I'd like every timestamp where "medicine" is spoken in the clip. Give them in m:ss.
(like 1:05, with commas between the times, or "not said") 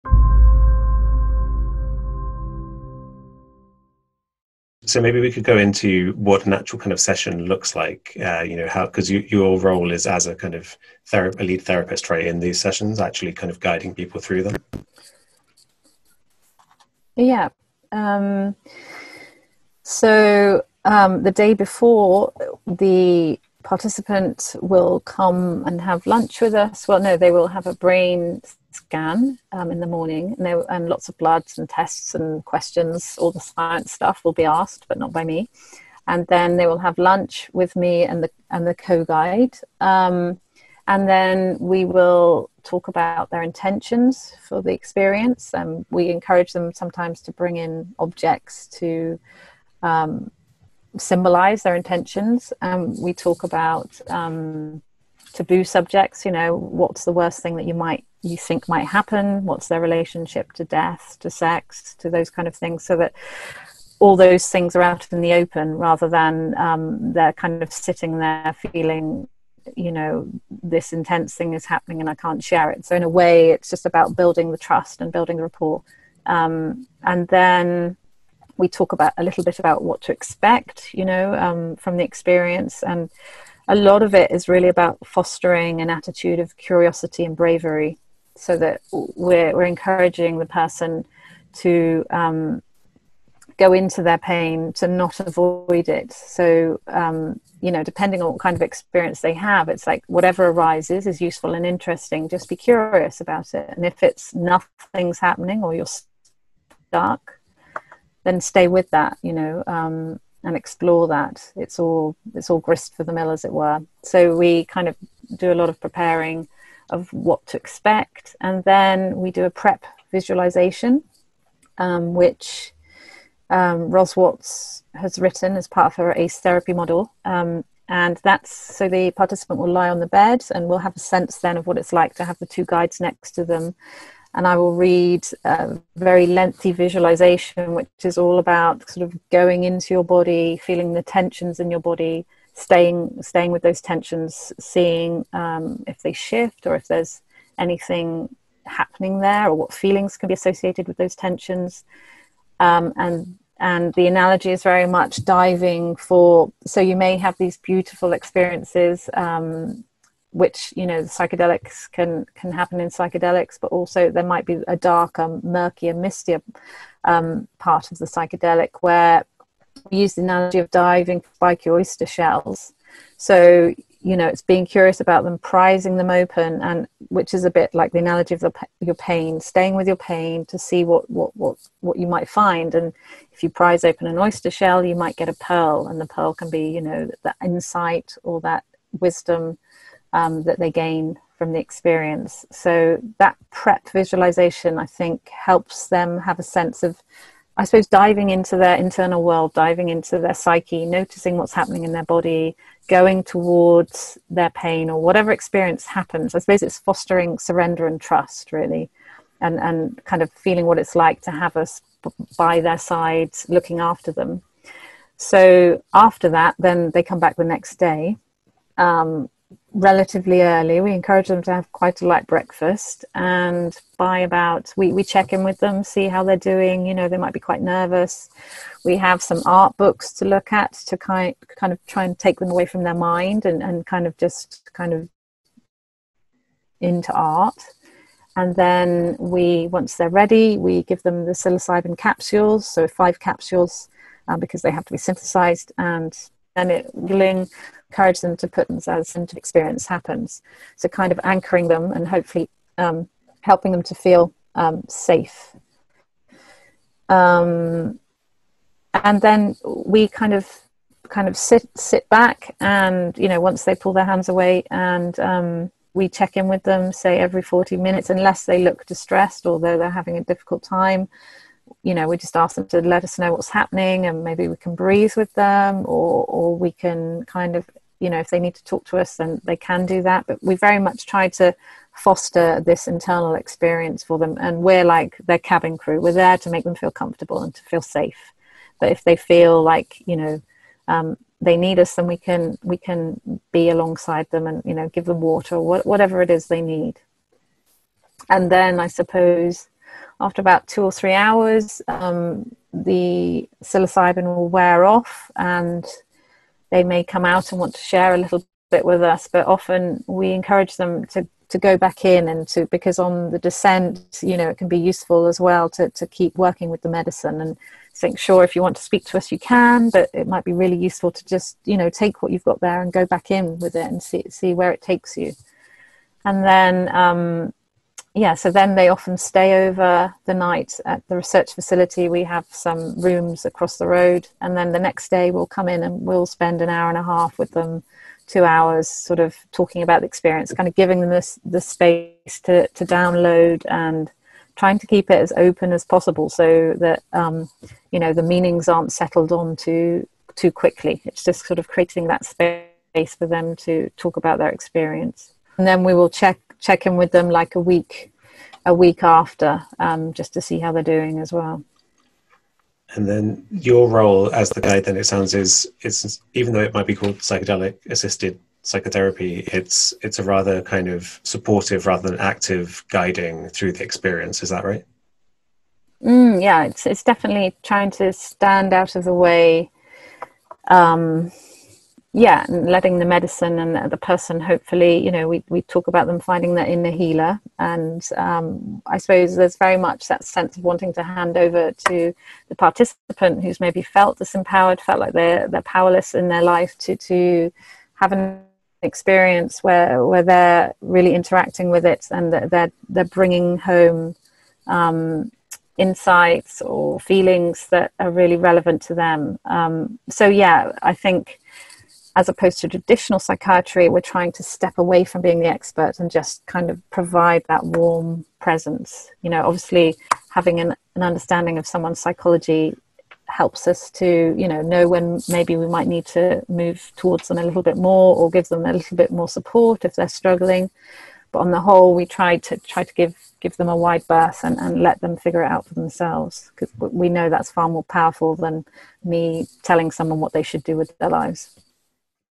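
5:16, 6:23.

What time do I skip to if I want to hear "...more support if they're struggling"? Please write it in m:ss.
7:09.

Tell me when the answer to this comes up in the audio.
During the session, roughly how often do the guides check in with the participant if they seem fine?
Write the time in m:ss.
4:27.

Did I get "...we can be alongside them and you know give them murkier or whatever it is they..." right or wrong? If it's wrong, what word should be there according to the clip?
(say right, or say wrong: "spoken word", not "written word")
wrong: "water", not "murkier".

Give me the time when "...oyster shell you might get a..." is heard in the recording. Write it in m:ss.
3:04.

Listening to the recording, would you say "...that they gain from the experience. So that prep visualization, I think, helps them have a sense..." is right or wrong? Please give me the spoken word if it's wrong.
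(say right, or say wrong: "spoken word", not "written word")
right.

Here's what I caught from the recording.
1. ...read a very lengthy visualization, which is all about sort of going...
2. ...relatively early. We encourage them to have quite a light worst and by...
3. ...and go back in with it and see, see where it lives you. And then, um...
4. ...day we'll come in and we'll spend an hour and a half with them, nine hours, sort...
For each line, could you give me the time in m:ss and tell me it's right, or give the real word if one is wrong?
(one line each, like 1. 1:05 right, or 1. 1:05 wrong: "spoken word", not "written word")
1. 2:14 right
2. 3:39 wrong: "breakfast", not "worst"
3. 5:22 wrong: "takes", not "lives"
4. 5:35 wrong: "two", not "nine".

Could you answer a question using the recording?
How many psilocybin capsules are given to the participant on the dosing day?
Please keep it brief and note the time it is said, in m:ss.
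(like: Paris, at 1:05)
5, at 4:02.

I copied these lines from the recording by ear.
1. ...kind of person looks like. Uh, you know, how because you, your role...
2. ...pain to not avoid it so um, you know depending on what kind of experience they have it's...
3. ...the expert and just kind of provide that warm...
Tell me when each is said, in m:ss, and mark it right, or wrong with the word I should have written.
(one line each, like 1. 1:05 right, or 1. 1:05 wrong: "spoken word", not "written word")
1. 0:06 wrong: "session", not "person"
2. 1:34 right
3. 6:55 right.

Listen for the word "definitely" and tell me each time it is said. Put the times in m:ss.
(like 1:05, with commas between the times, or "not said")
6:17.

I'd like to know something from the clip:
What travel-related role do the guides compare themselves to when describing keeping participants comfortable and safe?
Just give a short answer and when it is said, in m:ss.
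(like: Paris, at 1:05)
Cabin crew, at 4:45.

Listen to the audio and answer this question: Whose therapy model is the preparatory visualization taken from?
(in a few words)
Ros Watts.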